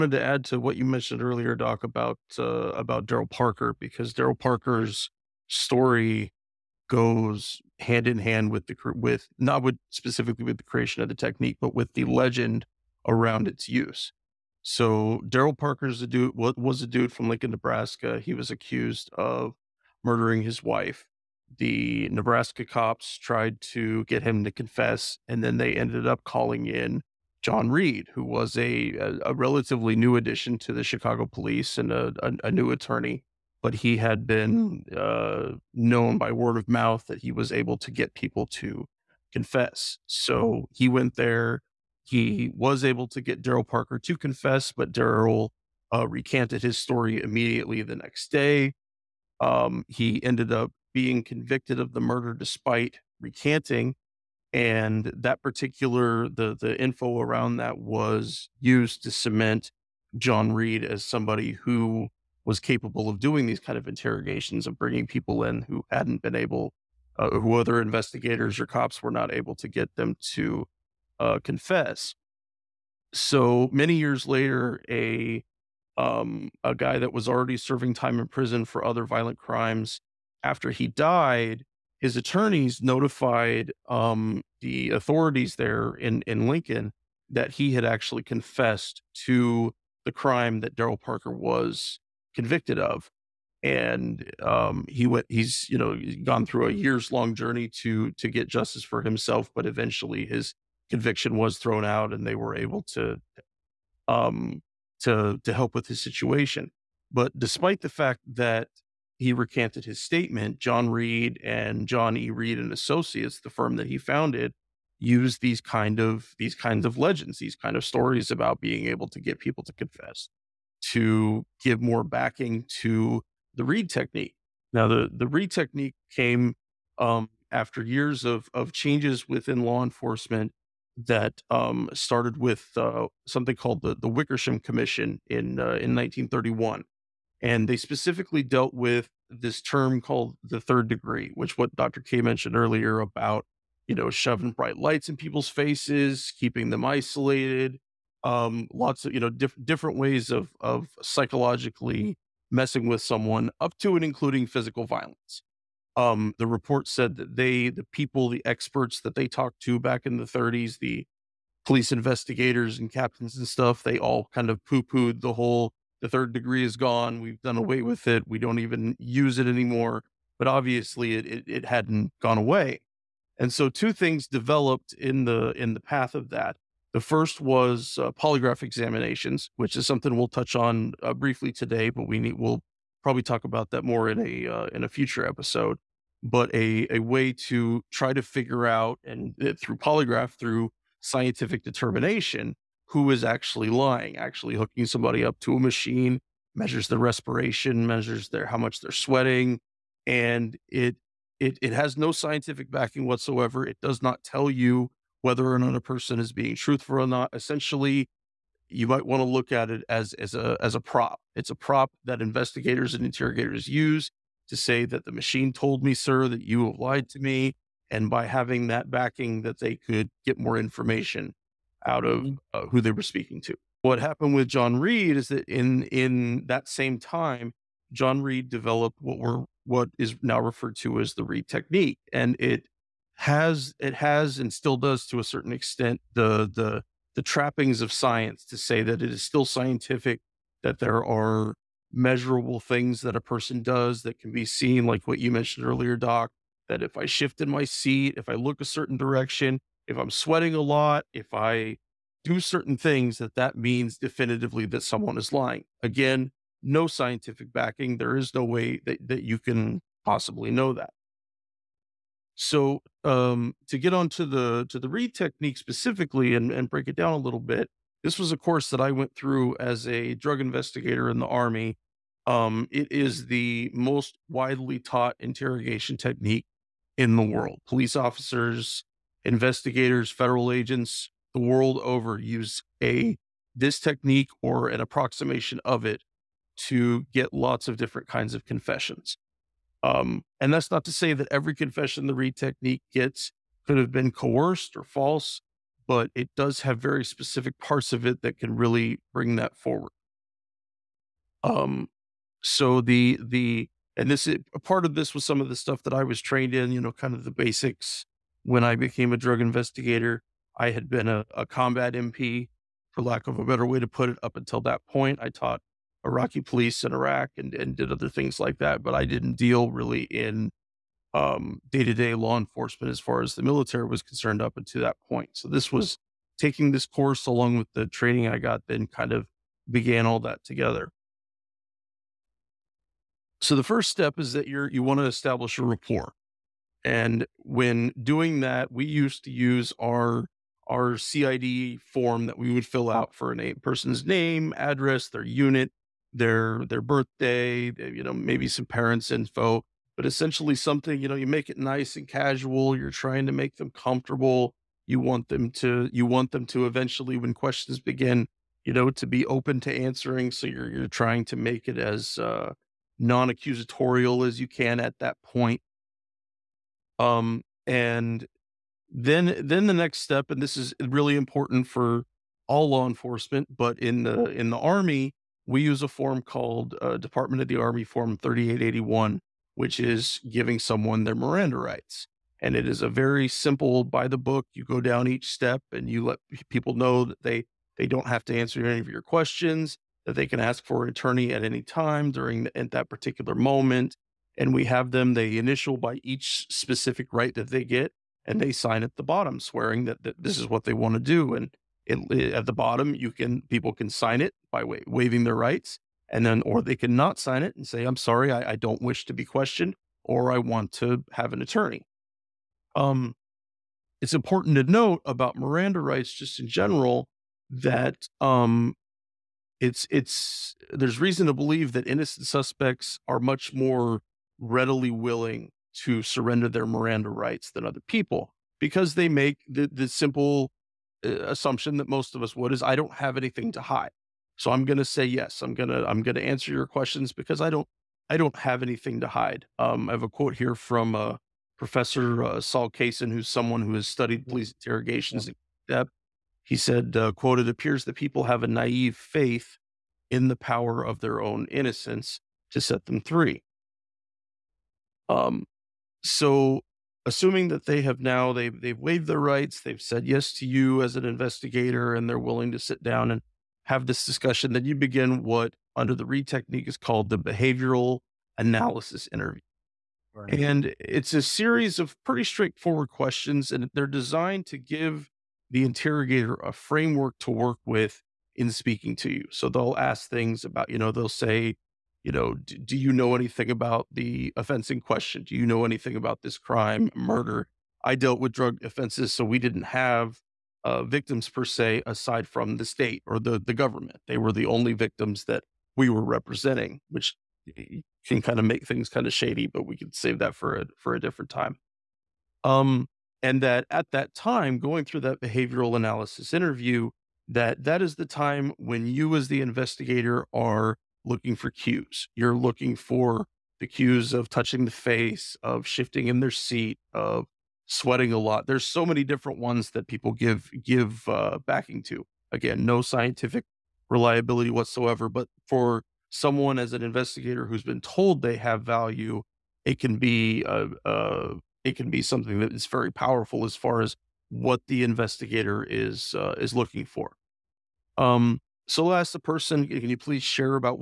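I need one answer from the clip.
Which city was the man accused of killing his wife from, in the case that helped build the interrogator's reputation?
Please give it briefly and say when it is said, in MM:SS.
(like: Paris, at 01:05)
Lincoln, Nebraska, at 00:17.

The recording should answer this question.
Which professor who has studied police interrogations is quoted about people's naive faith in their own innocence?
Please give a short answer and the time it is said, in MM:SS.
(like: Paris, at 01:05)
Saul Kassin, at 07:22.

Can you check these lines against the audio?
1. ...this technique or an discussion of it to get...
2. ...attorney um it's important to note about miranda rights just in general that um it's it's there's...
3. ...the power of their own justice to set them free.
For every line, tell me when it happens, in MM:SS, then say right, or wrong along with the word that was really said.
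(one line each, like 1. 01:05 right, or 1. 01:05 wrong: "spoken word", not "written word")
1. 04:43 wrong: "approximation", not "discussion"
2. 06:51 right
3. 07:30 wrong: "innocence", not "justice".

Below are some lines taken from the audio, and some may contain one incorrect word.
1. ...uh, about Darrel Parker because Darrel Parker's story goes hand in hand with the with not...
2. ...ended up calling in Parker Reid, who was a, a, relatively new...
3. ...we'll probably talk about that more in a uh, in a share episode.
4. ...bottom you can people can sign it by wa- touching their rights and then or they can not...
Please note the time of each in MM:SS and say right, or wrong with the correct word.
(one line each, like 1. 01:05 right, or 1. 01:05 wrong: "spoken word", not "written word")
1. 00:02 right
2. 00:25 wrong: "John", not "Parker"
3. 03:02 wrong: "future", not "share"
4. 06:42 wrong: "waiving", not "touching".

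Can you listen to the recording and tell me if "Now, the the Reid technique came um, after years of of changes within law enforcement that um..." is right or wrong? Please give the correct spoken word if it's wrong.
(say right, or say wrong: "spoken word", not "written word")
right.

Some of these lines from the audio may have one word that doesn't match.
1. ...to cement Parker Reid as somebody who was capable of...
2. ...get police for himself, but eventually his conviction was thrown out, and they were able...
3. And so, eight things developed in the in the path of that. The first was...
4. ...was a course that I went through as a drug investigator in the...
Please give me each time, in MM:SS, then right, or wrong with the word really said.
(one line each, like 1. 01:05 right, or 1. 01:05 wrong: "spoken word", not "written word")
1. 00:59 wrong: "John", not "Parker"
2. 01:38 wrong: "justice", not "police"
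3. 02:53 wrong: "two", not "eight"
4. 04:28 right.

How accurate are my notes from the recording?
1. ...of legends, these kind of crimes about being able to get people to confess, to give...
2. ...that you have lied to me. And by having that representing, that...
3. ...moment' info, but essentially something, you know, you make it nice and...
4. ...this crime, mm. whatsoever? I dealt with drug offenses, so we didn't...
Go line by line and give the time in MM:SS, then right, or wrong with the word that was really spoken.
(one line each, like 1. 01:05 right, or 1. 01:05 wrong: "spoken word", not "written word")
1. 01:56 wrong: "stories", not "crimes"
2. 03:36 wrong: "backing", not "representing"
3. 05:48 wrong: "parents", not "moment"
4. 08:06 wrong: "murder", not "whatsoever".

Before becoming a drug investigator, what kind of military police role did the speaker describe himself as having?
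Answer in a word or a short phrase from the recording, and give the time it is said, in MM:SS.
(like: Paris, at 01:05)
combat MP, at 05:11.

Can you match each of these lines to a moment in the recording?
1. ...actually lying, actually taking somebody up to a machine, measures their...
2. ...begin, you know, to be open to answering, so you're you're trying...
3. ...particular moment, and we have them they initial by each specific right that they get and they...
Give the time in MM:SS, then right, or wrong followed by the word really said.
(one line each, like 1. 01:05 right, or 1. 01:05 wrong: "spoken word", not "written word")
1. 03:13 wrong: "hooking", not "taking"
2. 05:57 right
3. 06:32 right.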